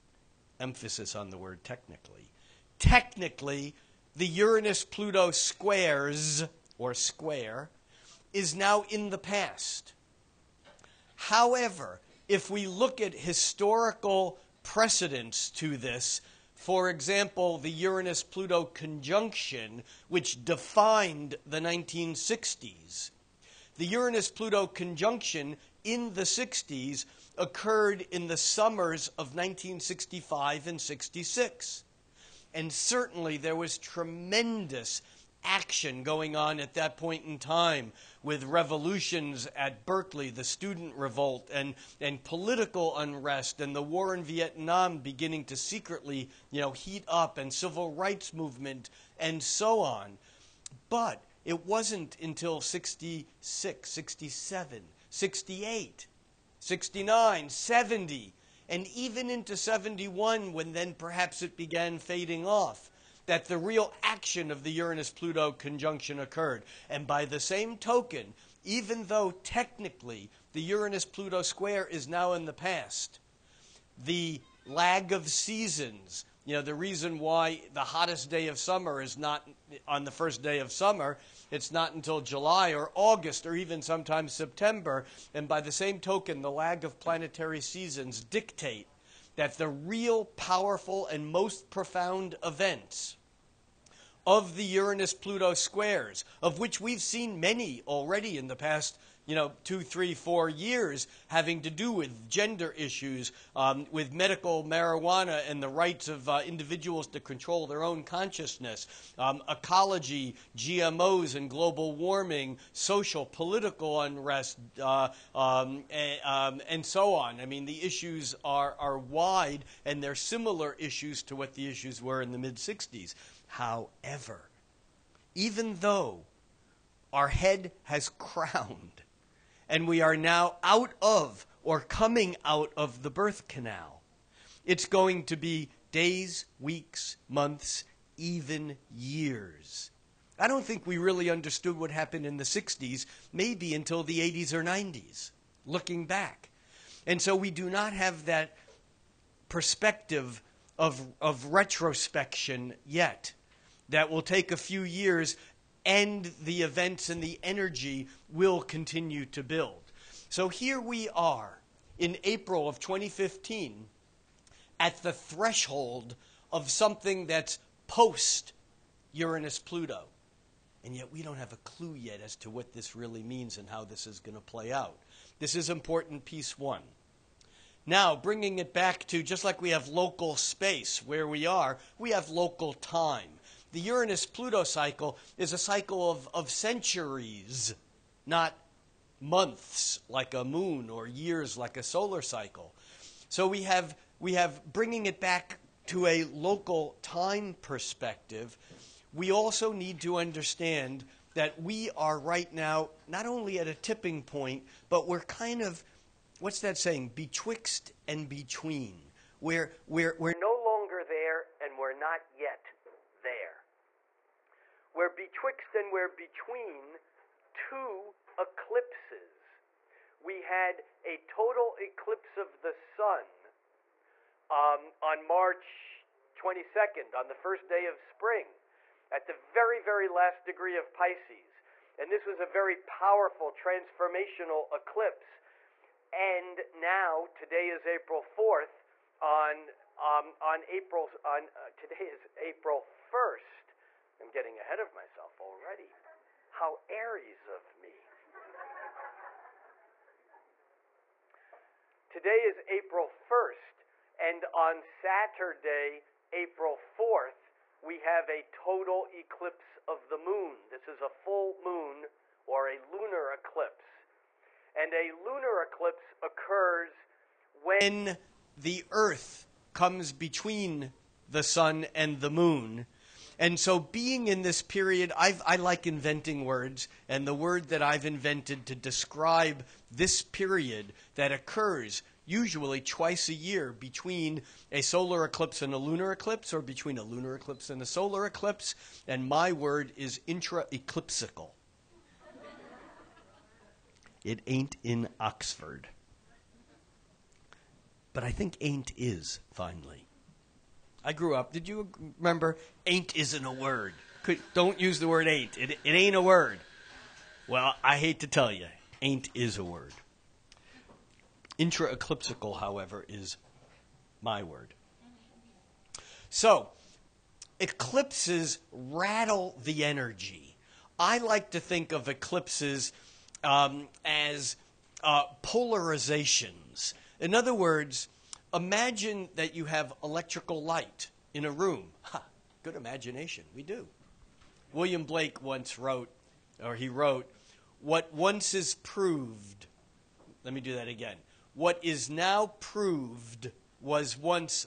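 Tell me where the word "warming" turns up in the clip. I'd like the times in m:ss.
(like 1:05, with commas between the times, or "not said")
1:51.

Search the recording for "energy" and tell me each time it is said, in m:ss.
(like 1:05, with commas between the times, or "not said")
2:37, 5:19.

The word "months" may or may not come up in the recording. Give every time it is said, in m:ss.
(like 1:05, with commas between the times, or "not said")
2:17, 3:09.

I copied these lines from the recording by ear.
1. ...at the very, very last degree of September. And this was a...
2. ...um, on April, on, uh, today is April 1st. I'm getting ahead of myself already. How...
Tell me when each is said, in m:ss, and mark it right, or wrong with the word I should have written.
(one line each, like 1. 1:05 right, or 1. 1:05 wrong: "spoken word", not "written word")
1. 3:49 wrong: "Pisces", not "September"
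2. 3:59 right.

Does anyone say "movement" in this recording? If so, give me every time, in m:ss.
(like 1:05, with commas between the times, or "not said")
0:48.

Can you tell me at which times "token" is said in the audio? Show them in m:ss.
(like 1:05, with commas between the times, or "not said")
1:07, 1:25.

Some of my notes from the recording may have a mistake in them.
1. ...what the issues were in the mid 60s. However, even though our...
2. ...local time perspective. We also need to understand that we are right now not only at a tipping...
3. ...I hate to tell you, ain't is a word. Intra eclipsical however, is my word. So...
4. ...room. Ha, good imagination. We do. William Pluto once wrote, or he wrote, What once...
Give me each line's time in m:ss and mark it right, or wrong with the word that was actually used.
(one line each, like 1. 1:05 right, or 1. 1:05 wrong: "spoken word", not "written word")
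1. 2:01 right
2. 3:16 right
3. 5:07 right
4. 5:31 wrong: "Blake", not "Pluto".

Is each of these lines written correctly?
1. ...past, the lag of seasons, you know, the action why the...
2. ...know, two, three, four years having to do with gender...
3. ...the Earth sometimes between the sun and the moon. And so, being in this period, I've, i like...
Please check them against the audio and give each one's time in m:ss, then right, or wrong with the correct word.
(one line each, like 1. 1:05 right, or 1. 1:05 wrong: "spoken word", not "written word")
1. 1:12 wrong: "reason", not "action"
2. 1:39 right
3. 4:28 wrong: "comes", not "sometimes".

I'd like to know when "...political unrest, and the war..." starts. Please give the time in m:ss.
0:42.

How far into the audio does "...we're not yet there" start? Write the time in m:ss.
3:31.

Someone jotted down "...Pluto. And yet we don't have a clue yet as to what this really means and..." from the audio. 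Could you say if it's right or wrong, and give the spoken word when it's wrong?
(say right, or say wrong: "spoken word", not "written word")
right.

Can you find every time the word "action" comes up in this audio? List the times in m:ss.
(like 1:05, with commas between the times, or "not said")
0:35, 1:04.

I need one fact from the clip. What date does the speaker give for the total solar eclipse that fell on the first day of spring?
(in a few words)
March 22nd.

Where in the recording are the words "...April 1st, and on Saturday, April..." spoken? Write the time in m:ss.
4:12.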